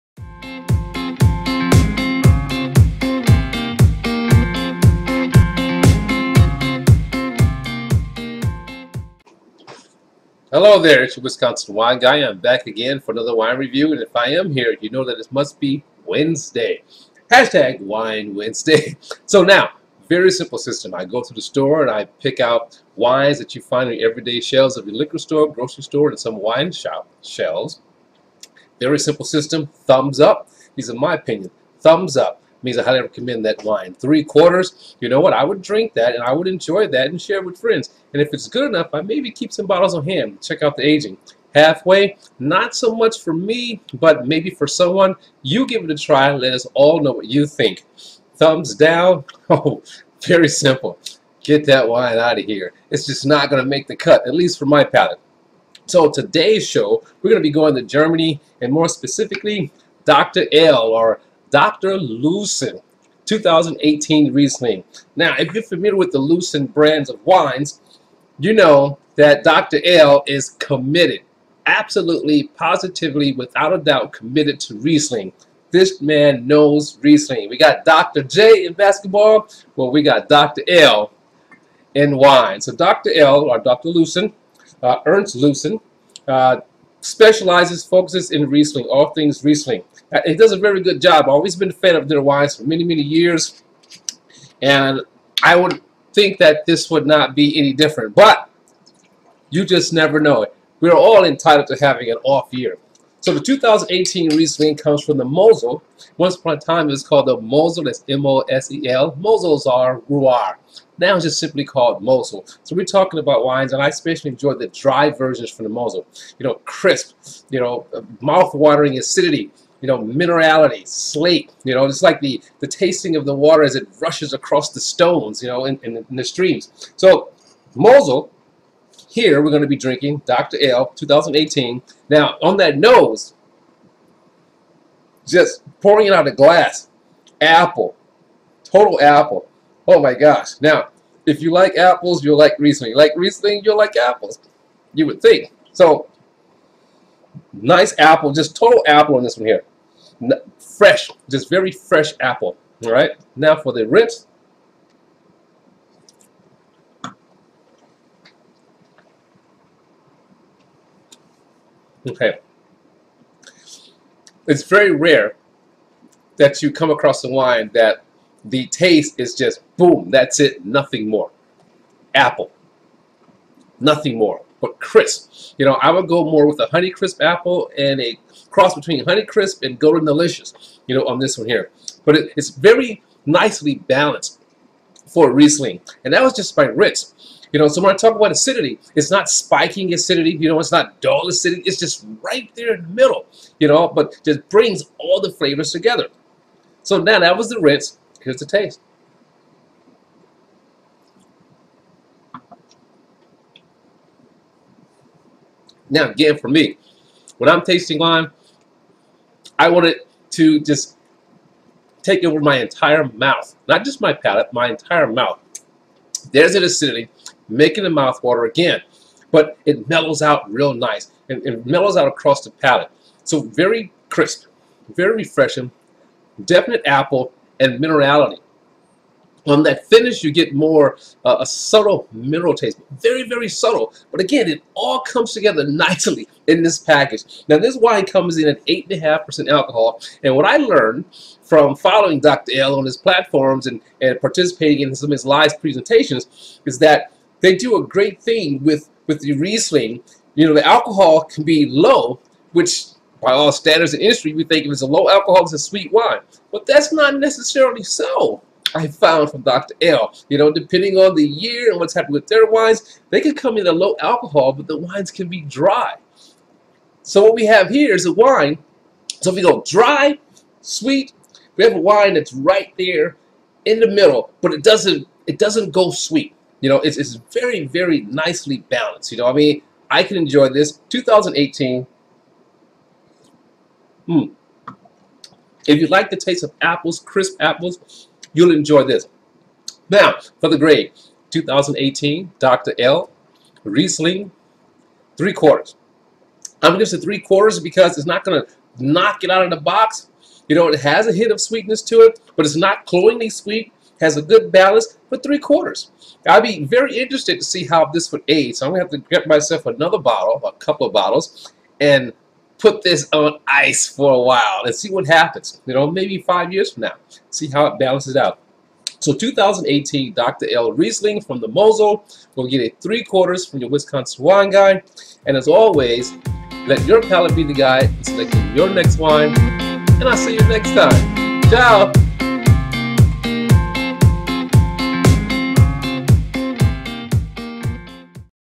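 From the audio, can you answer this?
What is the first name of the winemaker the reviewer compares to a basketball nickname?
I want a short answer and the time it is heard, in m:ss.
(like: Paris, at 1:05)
Ernst, at 1:25.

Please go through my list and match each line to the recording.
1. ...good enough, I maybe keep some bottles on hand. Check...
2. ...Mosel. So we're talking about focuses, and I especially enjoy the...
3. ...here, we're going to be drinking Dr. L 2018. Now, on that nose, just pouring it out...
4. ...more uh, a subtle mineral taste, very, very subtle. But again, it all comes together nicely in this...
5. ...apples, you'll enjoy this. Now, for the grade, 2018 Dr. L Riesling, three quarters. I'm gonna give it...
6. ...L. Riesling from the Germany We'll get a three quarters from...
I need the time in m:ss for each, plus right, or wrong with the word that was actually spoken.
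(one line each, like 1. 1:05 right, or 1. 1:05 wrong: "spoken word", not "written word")
1. 0:38 right
2. 1:52 wrong: "wines", not "focuses"
3. 2:09 right
4. 3:50 right
5. 4:47 right
6. 5:20 wrong: "Mosel", not "Germany".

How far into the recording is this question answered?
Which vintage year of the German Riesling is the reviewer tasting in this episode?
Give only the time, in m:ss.
1:01.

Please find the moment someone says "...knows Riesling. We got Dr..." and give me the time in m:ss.
1:16.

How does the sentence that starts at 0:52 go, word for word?
It's just not going to make the cut, at least for my palate.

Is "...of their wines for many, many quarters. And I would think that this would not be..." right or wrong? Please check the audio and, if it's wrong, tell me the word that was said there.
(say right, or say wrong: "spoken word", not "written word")
wrong: "years", not "quarters".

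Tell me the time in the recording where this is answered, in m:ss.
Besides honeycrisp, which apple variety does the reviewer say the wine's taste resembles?
2:59.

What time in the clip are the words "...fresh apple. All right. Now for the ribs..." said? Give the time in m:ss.
2:31.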